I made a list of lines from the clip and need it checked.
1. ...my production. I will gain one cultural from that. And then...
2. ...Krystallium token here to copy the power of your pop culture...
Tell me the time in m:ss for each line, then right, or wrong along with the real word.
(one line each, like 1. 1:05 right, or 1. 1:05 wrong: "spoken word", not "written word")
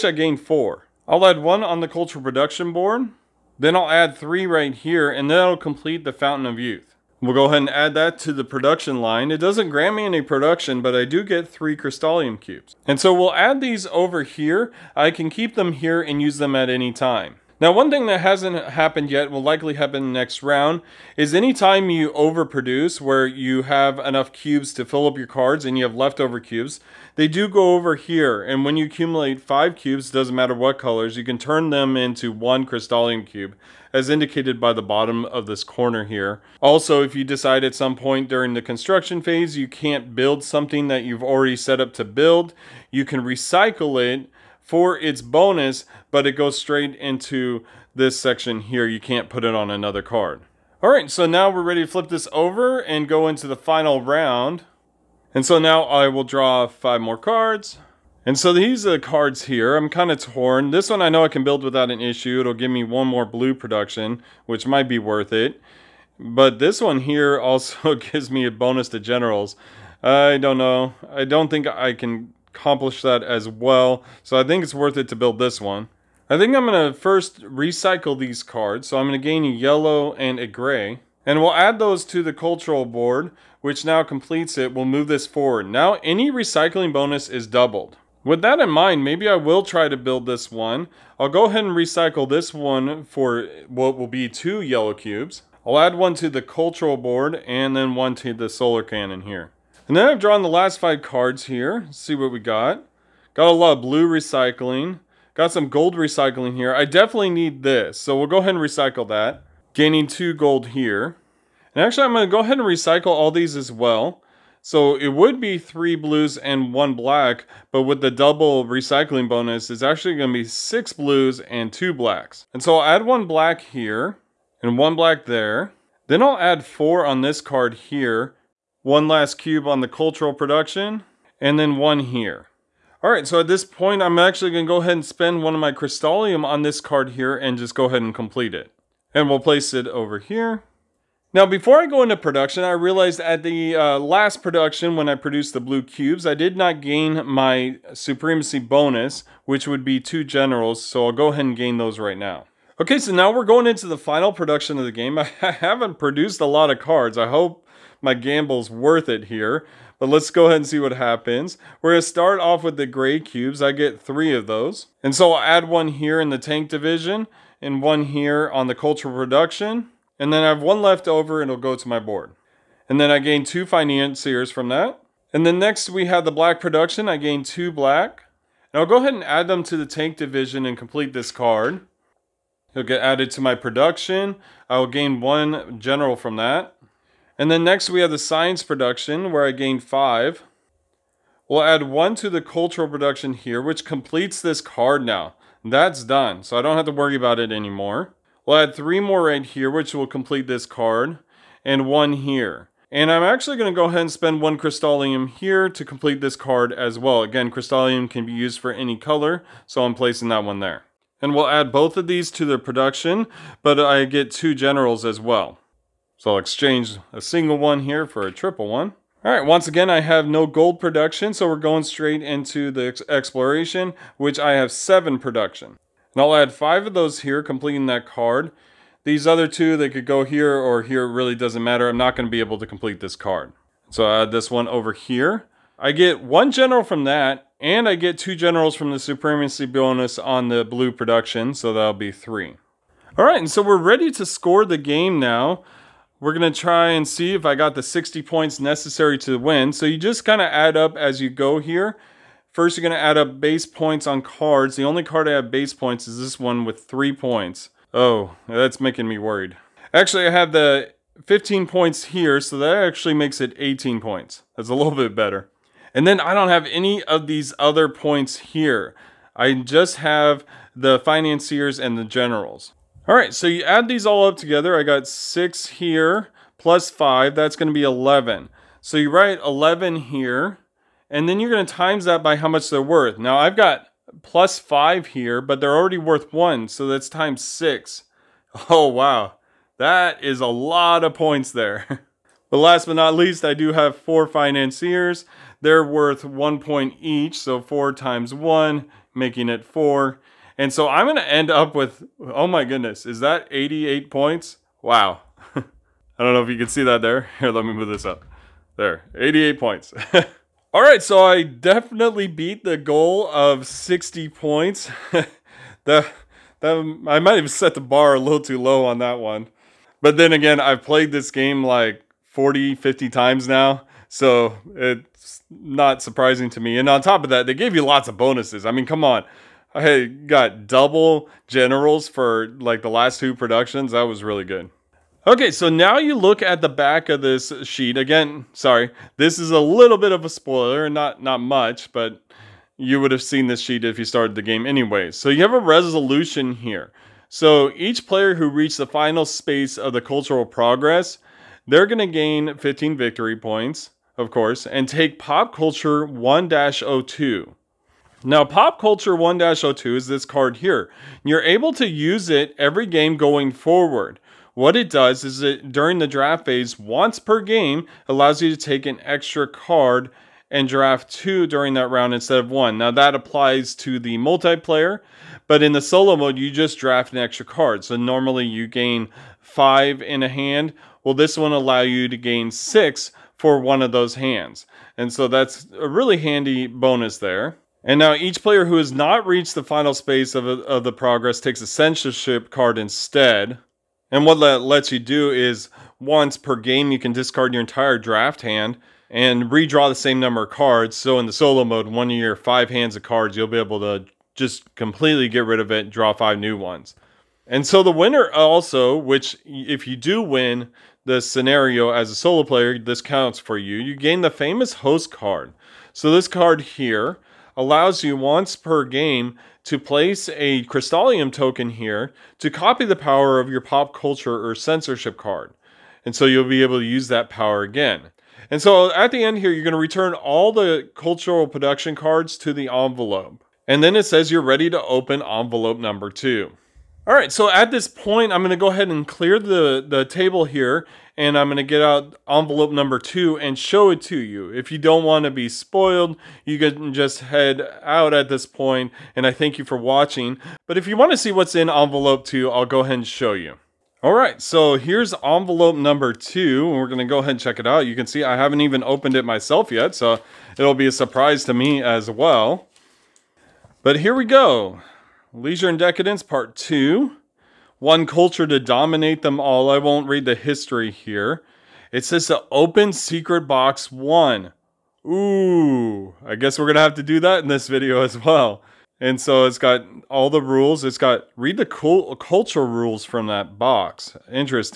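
1. 3:03 wrong: "general", not "cultural"
2. 7:00 right.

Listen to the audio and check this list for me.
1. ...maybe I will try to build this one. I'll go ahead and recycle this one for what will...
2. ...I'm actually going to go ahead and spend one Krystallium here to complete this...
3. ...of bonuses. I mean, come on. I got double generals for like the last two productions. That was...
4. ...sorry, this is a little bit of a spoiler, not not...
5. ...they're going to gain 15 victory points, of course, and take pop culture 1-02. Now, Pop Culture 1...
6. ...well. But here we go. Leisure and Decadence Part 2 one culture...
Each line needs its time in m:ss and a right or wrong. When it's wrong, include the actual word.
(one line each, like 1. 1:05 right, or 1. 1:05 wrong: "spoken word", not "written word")
1. 1:29 right
2. 3:23 right
3. 5:28 right
4. 5:38 right
5. 5:51 right
6. 7:42 right.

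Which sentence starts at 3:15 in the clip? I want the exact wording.
That's done, so I don't have to worry about it anymore.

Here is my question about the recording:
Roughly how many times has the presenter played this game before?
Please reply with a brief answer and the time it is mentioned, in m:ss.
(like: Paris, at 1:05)
40 or 50 times, at 5:22.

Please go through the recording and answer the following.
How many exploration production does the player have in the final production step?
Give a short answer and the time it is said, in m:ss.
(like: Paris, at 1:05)
7, at 3:44.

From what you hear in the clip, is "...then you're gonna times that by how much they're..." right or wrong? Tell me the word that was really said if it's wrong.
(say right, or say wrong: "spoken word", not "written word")
right.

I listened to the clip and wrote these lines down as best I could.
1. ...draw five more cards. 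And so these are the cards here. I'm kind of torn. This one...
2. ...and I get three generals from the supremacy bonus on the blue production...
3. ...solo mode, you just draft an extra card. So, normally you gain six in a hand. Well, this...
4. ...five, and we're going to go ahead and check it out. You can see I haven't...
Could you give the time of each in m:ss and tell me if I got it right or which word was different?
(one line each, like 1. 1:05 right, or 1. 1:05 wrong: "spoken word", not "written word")
1. 0:56 right
2. 3:57 wrong: "two", not "three"
3. 6:15 wrong: "five", not "six"
4. 7:36 wrong: "two", not "five".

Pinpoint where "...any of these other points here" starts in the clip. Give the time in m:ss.
4:26.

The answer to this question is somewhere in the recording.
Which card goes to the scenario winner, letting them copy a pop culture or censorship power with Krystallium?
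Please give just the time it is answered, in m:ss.
6:54.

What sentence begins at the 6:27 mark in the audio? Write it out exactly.
And now each player who has not reached the final space of, a, of the progress takes a censorship card instead.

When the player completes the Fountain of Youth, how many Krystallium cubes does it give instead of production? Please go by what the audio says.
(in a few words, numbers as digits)
3.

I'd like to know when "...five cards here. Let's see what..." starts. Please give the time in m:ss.
1:40.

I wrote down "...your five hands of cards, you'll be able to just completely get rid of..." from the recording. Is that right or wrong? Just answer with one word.
right.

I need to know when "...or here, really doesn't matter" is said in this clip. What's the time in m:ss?
3:50.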